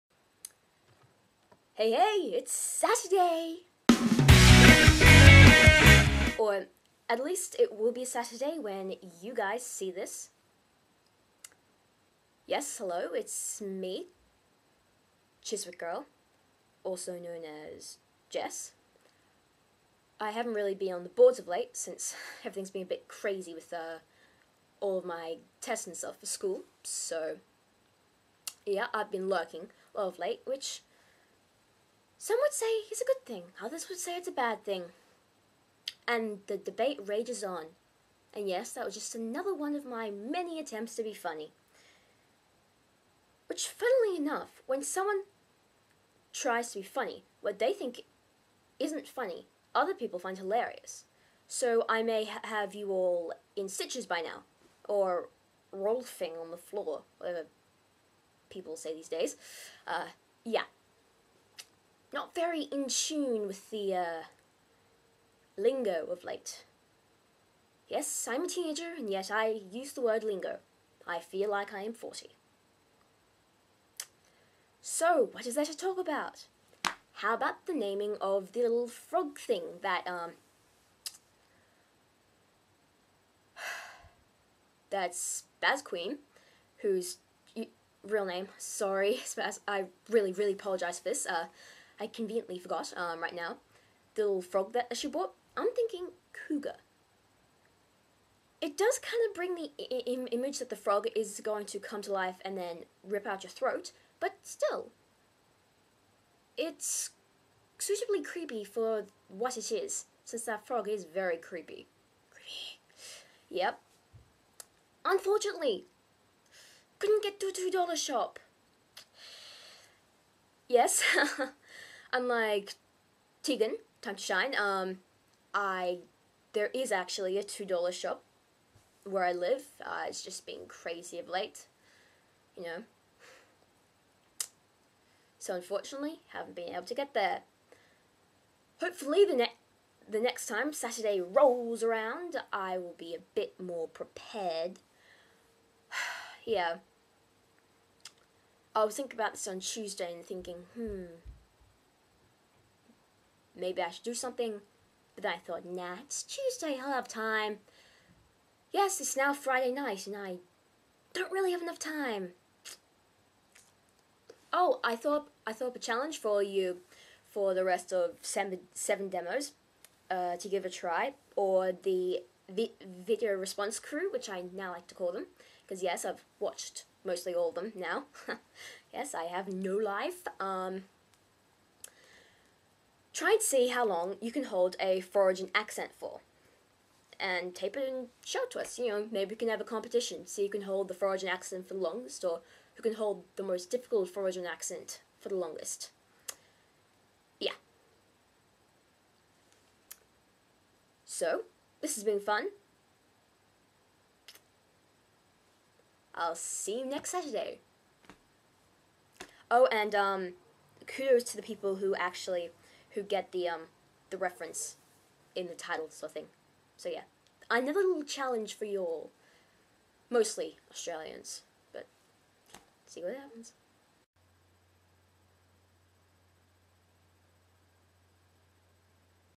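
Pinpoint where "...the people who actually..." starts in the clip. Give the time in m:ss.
3:31.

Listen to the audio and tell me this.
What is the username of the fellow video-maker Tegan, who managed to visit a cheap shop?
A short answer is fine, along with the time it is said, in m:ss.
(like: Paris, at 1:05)
Time to Shine, at 2:04.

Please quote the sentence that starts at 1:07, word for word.
Yes, I'm a teenager, and yet I use the word lingo.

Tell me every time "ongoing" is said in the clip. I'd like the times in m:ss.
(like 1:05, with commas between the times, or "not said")
not said.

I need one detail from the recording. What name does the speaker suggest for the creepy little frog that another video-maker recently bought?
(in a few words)
Cougar.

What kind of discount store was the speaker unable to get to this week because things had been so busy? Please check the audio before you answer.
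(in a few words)
$2 shop.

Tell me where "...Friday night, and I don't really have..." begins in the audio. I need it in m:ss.
2:39.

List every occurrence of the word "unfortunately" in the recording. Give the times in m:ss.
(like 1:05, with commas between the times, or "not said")
1:55, 2:15.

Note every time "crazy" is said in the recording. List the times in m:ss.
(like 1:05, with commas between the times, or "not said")
0:23, 2:10.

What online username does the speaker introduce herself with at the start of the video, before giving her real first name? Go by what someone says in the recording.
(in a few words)
Chiswick Girl.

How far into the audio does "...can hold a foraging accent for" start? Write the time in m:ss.
3:04.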